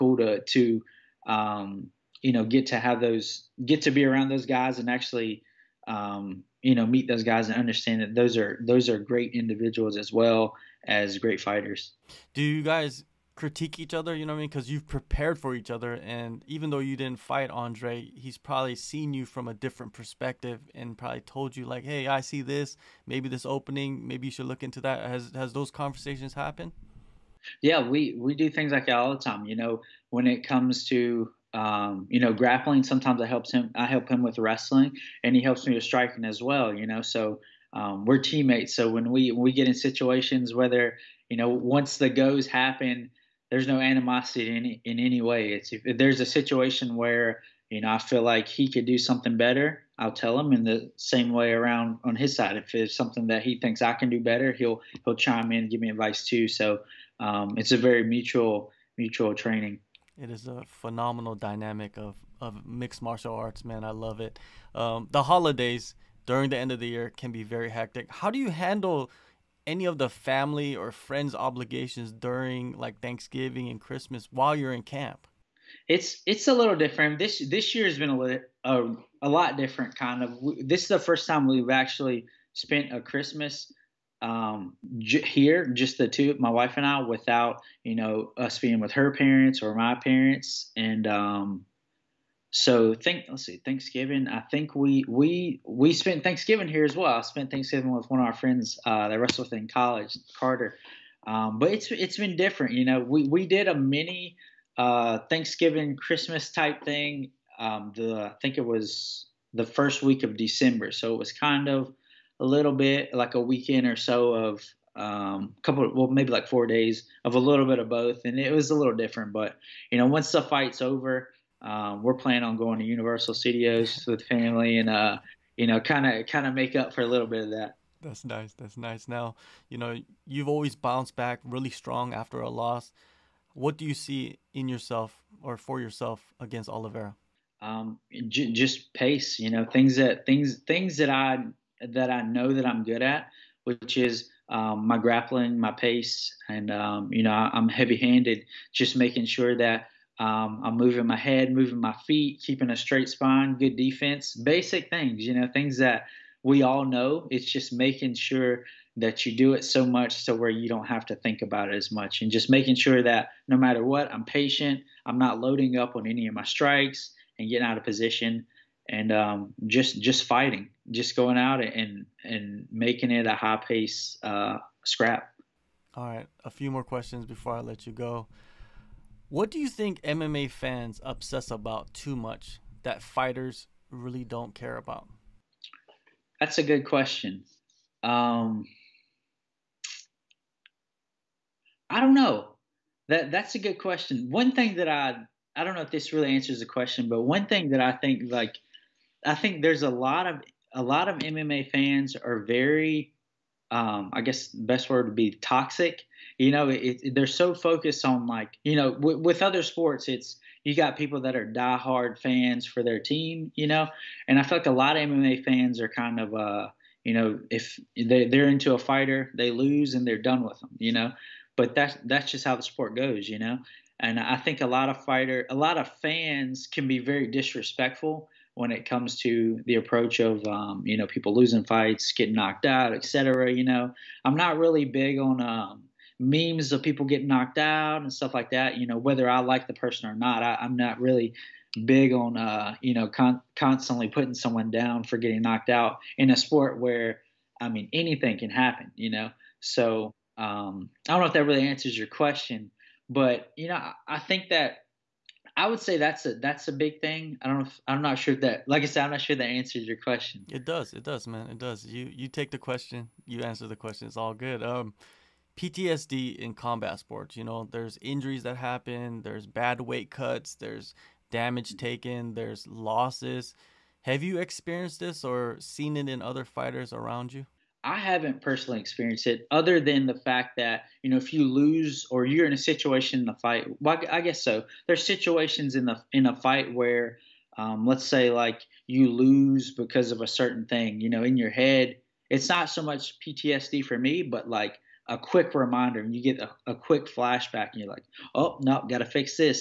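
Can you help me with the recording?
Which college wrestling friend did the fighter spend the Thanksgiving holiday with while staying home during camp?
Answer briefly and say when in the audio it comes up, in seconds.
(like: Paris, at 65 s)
Carter, at 100 s.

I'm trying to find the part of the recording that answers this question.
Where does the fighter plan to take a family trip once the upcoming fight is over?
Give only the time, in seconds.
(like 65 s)
122 s.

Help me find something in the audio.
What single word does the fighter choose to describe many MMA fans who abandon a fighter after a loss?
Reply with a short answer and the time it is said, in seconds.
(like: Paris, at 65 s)
toxic, at 205 s.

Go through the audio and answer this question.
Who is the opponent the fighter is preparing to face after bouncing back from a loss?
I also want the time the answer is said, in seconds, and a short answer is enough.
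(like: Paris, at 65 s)
Oliveira, at 136 s.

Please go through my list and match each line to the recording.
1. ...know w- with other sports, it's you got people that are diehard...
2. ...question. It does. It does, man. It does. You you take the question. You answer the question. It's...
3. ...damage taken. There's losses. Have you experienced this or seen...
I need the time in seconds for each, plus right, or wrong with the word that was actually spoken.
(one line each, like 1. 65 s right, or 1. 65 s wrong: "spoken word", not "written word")
1. 208 s right
2. 259 s right
3. 271 s right.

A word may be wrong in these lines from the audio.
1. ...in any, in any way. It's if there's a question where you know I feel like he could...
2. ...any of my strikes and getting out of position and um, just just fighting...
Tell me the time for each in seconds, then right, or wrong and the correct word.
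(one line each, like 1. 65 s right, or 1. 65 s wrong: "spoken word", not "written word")
1. 44 s wrong: "situation", not "question"
2. 166 s right.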